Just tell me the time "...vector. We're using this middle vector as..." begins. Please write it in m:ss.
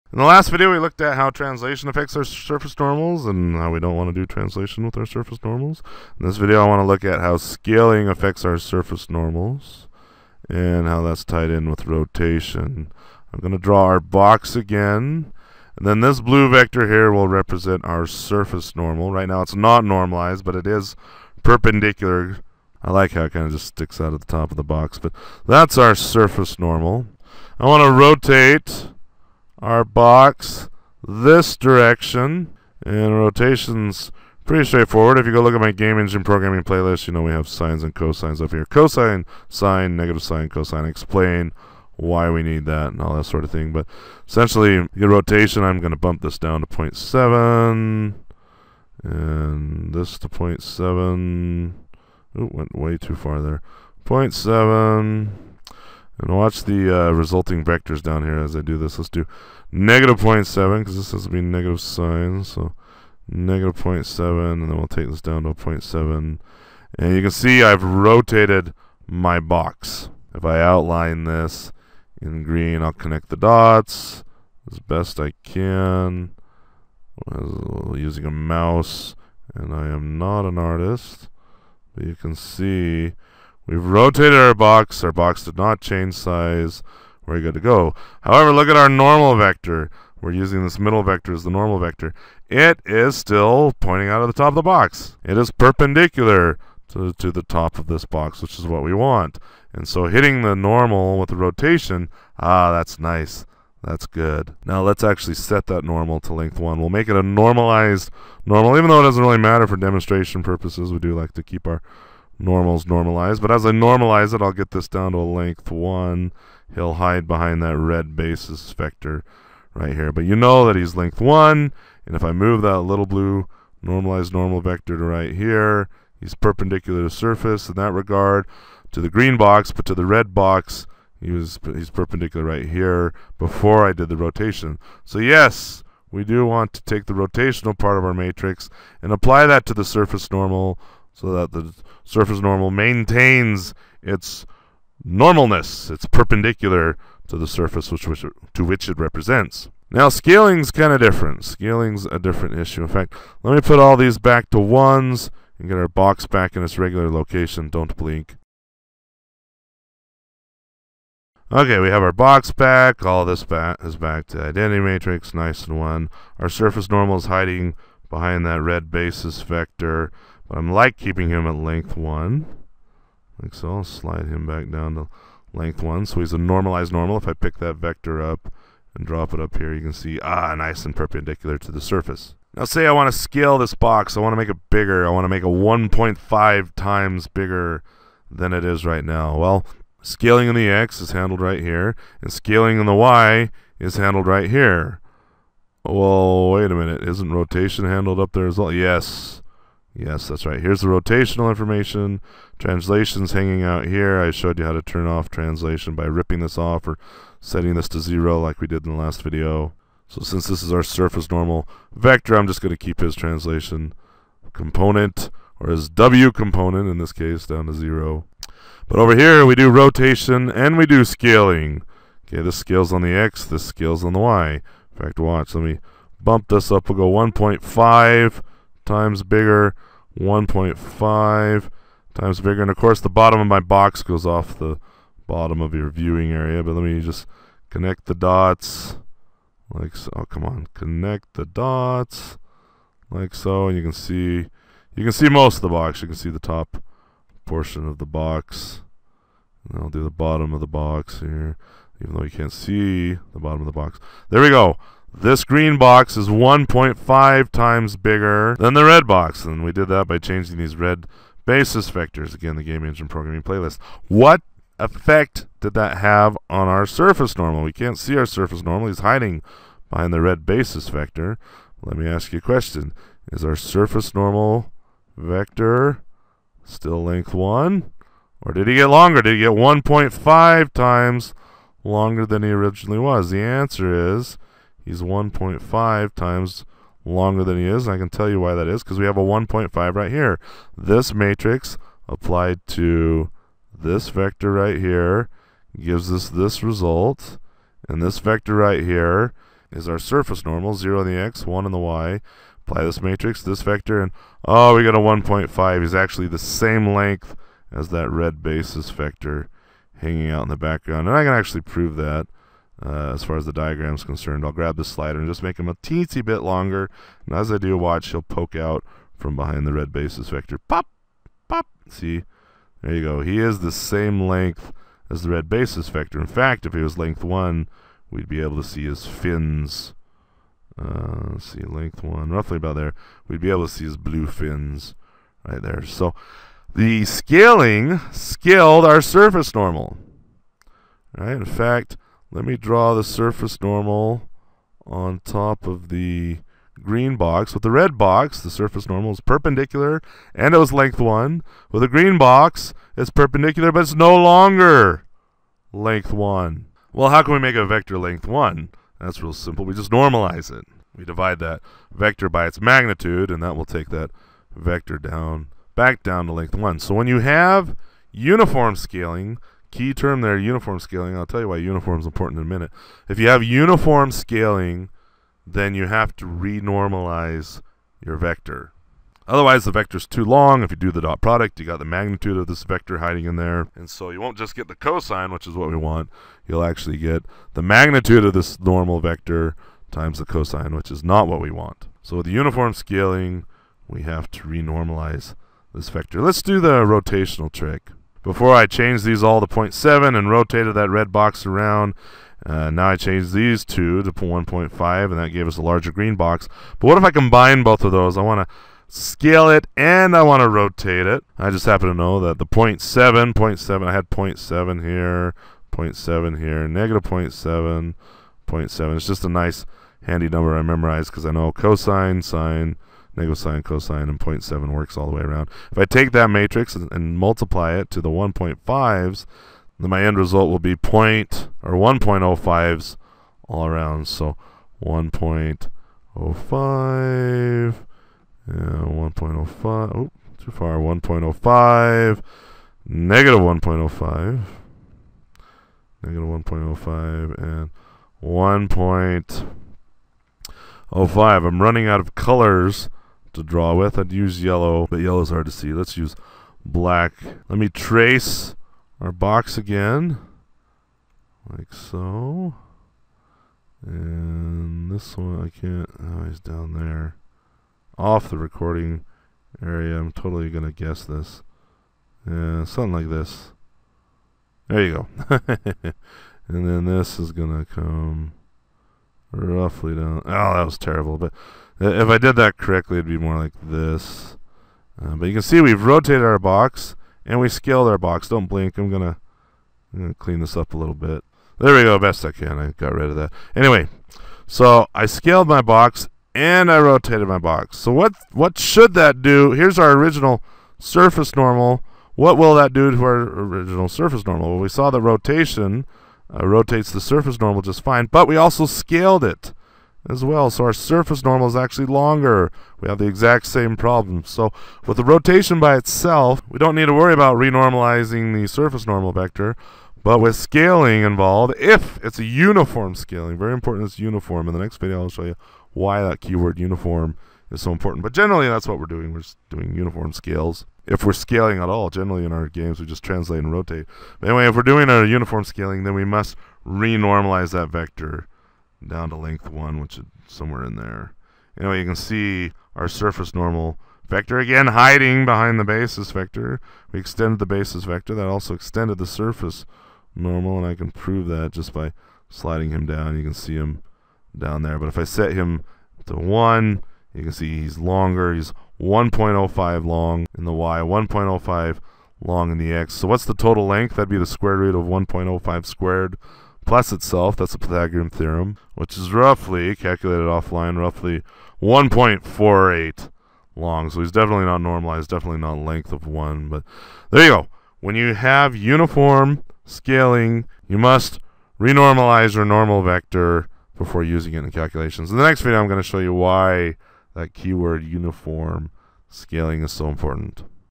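1:29.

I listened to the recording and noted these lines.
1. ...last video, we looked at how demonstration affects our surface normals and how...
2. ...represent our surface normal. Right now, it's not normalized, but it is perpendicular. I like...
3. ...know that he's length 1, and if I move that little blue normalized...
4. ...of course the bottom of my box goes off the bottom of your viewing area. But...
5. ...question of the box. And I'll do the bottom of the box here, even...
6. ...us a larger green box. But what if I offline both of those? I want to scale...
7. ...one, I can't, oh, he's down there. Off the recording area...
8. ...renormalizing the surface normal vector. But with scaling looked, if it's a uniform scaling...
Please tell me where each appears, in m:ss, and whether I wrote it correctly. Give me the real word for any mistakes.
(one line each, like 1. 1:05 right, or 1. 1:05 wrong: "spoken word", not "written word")
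1. 0:00 wrong: "translation", not "demonstration"
2. 0:17 right
3. 2:00 right
4. 3:52 right
5. 4:07 wrong: "portion", not "question"
6. 6:45 wrong: "combine", not "offline"
7. 7:45 right
8. 8:37 wrong: "involved", not "looked".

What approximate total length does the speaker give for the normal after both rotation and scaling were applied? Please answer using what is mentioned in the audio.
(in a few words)
1.48.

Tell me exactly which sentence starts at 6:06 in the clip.
So when you have uniform scaling, Key term there, uniform scaling.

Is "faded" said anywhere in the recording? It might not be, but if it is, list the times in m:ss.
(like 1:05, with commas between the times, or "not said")
not said.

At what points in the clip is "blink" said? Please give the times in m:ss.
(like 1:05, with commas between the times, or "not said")
2:37, 8:08.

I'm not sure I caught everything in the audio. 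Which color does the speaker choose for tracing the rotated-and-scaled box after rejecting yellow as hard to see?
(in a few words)
Black.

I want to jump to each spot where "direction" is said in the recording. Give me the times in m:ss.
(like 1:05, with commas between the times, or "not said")
0:31.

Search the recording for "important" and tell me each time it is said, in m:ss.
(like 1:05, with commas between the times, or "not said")
6:12, 8:43, 8:47, 9:49.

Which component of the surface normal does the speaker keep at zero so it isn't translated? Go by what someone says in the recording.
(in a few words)
W component.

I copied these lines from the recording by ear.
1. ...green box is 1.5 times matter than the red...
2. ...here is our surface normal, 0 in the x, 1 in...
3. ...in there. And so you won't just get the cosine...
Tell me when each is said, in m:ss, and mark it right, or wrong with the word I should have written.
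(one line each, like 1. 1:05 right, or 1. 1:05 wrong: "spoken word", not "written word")
1. 4:15 wrong: "bigger", not "matter"
2. 4:58 right
3. 6:23 right.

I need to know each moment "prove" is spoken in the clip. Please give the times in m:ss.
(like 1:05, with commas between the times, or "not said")
5:11, 9:10.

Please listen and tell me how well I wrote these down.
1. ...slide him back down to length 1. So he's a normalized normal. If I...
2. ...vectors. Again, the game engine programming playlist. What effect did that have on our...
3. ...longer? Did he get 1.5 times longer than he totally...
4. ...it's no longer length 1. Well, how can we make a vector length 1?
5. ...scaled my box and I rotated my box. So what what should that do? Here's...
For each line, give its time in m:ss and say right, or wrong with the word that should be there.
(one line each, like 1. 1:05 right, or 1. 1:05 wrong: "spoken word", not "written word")
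1. 2:53 right
2. 4:21 right
3. 4:38 wrong: "originally", not "totally"
4. 5:53 right
5. 8:15 right.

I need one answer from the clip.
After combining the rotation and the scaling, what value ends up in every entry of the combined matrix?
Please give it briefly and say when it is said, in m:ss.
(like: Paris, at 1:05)
1.05, at 7:11.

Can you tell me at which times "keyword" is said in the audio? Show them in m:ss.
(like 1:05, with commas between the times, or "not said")
8:46, 9:47.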